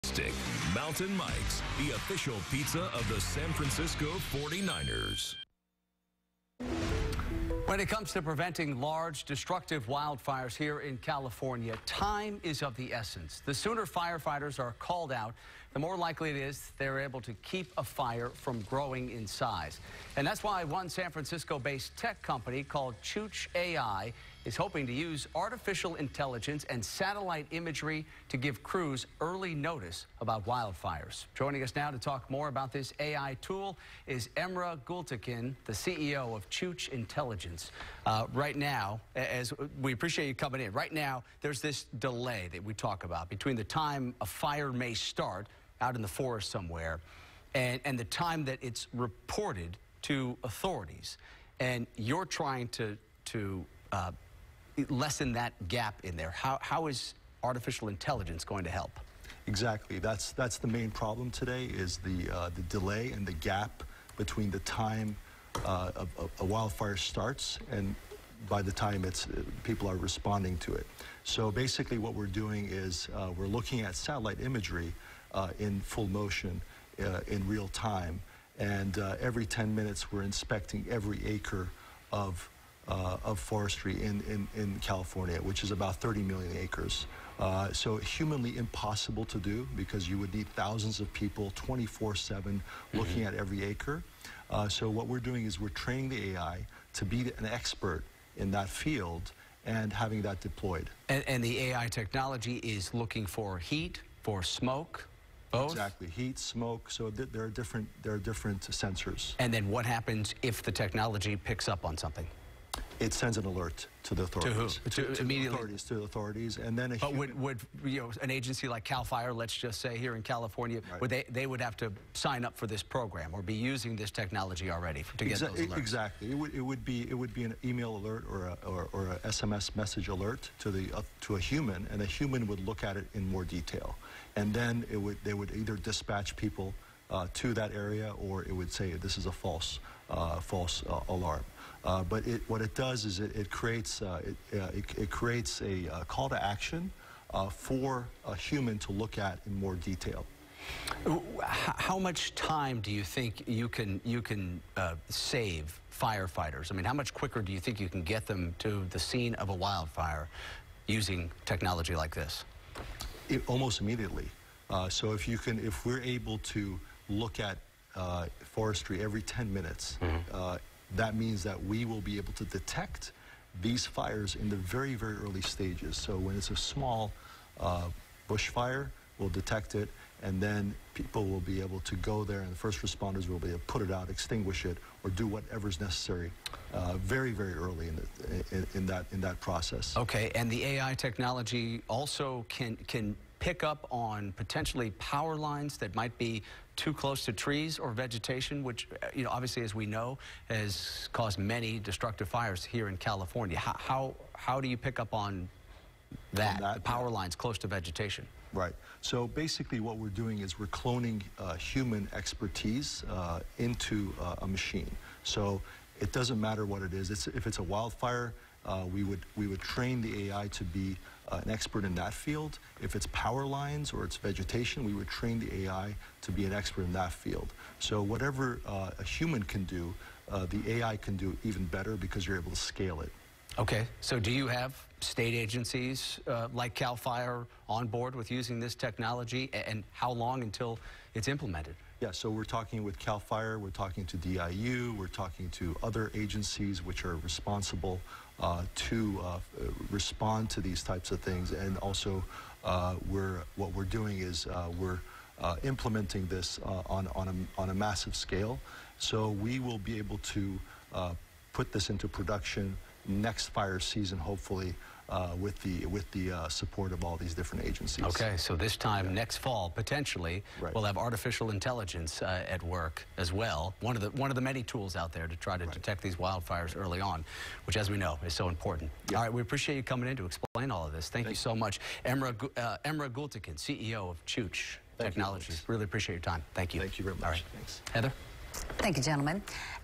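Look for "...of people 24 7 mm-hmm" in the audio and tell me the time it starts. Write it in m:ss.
1:30.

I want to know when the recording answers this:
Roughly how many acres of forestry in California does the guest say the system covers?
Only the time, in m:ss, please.
1:25.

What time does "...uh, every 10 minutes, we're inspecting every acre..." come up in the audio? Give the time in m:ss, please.
1:18.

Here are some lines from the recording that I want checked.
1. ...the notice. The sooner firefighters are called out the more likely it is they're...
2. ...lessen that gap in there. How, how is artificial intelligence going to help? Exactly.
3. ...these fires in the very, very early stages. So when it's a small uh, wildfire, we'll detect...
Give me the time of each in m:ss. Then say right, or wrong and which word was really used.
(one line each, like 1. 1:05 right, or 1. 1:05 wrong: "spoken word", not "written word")
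1. 0:12 wrong: "essence", not "notice"
2. 0:54 right
3. 2:53 wrong: "bushfire", not "wildfire".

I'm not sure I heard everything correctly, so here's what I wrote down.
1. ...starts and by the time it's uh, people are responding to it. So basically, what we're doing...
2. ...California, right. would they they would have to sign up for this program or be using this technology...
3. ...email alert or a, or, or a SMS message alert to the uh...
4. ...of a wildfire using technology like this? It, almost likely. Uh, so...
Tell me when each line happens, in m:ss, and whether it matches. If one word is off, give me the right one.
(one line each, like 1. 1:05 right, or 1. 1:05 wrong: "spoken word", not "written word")
1. 1:06 right
2. 2:00 right
3. 2:07 right
4. 2:39 wrong: "immediately", not "likely".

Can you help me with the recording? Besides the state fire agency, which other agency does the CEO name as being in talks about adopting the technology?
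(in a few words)
DIU.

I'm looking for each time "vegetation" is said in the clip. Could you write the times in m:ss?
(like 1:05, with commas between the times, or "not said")
3:17, 3:27, 3:44.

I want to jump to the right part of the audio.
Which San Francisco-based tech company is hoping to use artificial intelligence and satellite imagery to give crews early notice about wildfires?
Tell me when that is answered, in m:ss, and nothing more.
0:23.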